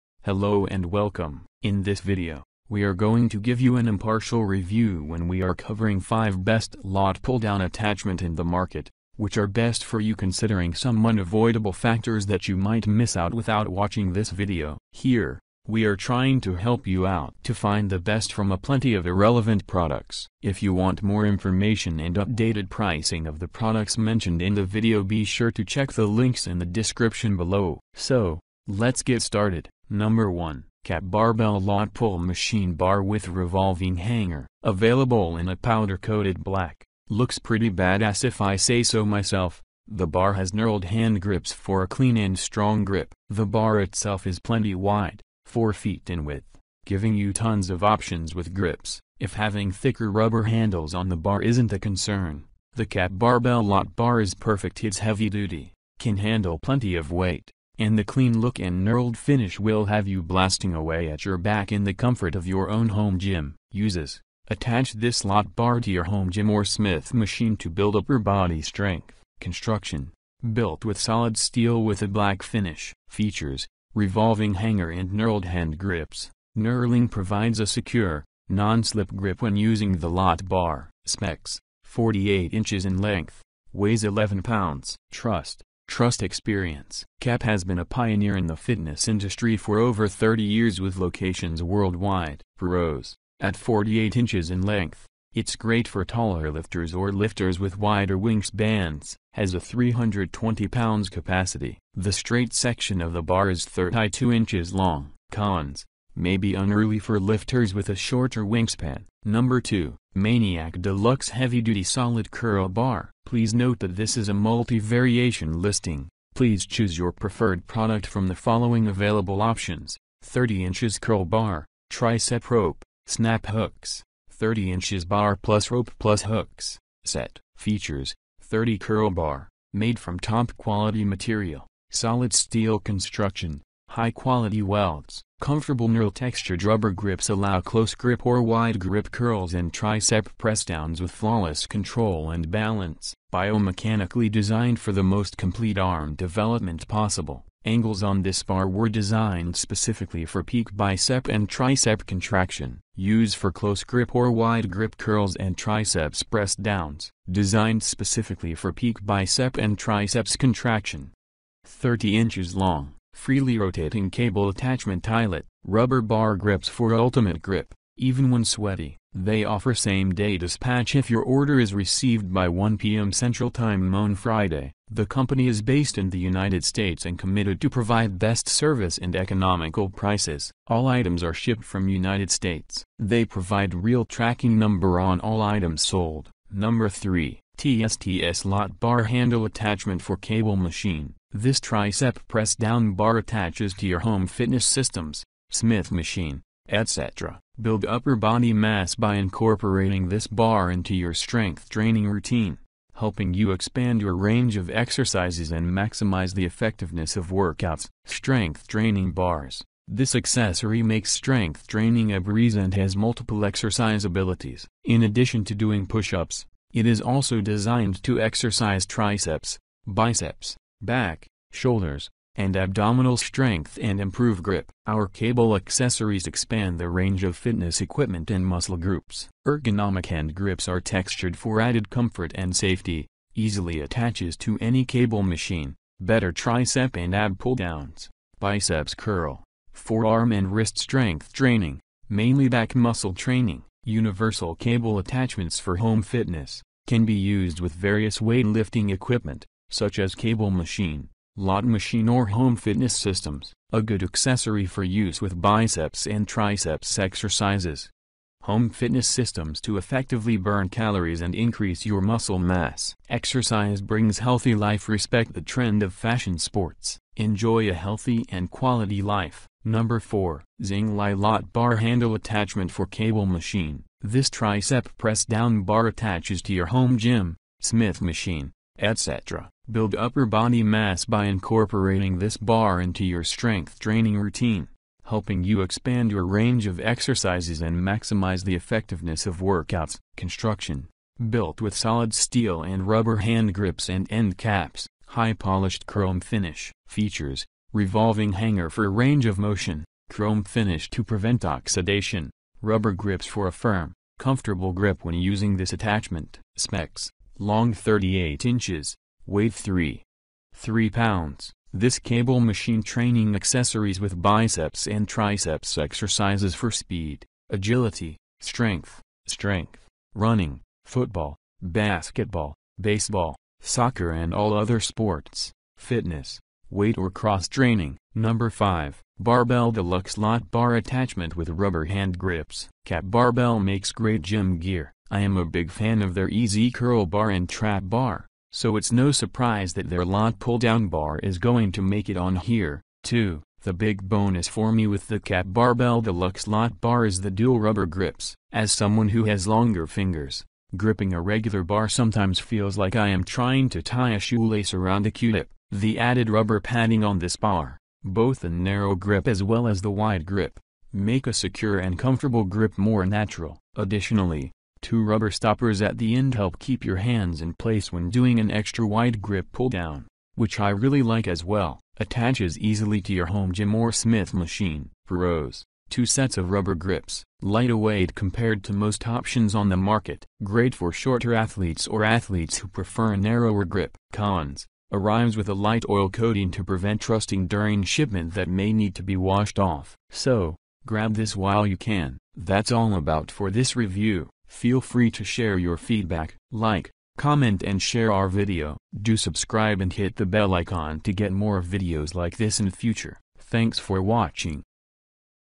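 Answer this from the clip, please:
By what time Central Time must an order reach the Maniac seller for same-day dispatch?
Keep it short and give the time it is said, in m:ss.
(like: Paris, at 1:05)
1 p.m., at 2:52.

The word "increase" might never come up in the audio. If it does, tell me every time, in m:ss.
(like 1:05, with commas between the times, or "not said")
4:21.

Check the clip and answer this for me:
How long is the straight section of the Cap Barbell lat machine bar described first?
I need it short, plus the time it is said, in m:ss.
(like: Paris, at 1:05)
32 inches, at 1:43.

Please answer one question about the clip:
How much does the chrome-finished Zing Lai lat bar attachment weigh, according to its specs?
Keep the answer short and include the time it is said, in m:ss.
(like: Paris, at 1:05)
3.3 pounds, at 5:09.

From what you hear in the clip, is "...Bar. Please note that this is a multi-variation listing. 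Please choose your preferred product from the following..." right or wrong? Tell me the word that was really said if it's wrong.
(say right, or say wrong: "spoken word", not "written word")
right.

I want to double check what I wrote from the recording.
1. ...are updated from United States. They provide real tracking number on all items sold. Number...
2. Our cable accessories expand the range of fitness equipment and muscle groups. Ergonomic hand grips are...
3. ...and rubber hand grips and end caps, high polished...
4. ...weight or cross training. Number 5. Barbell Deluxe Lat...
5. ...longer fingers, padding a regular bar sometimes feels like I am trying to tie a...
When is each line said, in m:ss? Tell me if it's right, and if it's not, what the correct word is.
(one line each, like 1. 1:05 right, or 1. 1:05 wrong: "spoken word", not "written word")
1. 3:01 wrong: "shipped", not "updated"
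2. 3:44 right
3. 4:52 right
4. 5:26 right
5. 5:49 wrong: "gripping", not "padding".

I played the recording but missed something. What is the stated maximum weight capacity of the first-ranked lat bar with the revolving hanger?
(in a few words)
320 pounds.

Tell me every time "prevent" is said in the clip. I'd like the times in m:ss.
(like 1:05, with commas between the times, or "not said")
5:01, 6:26.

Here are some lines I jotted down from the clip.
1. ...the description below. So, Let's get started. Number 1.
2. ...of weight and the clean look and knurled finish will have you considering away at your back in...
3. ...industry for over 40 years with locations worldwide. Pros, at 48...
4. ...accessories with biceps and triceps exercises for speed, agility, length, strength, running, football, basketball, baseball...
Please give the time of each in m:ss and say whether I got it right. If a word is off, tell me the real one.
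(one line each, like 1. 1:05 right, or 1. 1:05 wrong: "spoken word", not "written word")
1. 0:26 right
2. 0:56 wrong: "blasting", not "considering"
3. 1:29 wrong: "30", not "40"
4. 5:13 wrong: "strength", not "length".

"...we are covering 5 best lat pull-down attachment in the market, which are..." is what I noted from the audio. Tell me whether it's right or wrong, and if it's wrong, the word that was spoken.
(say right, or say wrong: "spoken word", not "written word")
right.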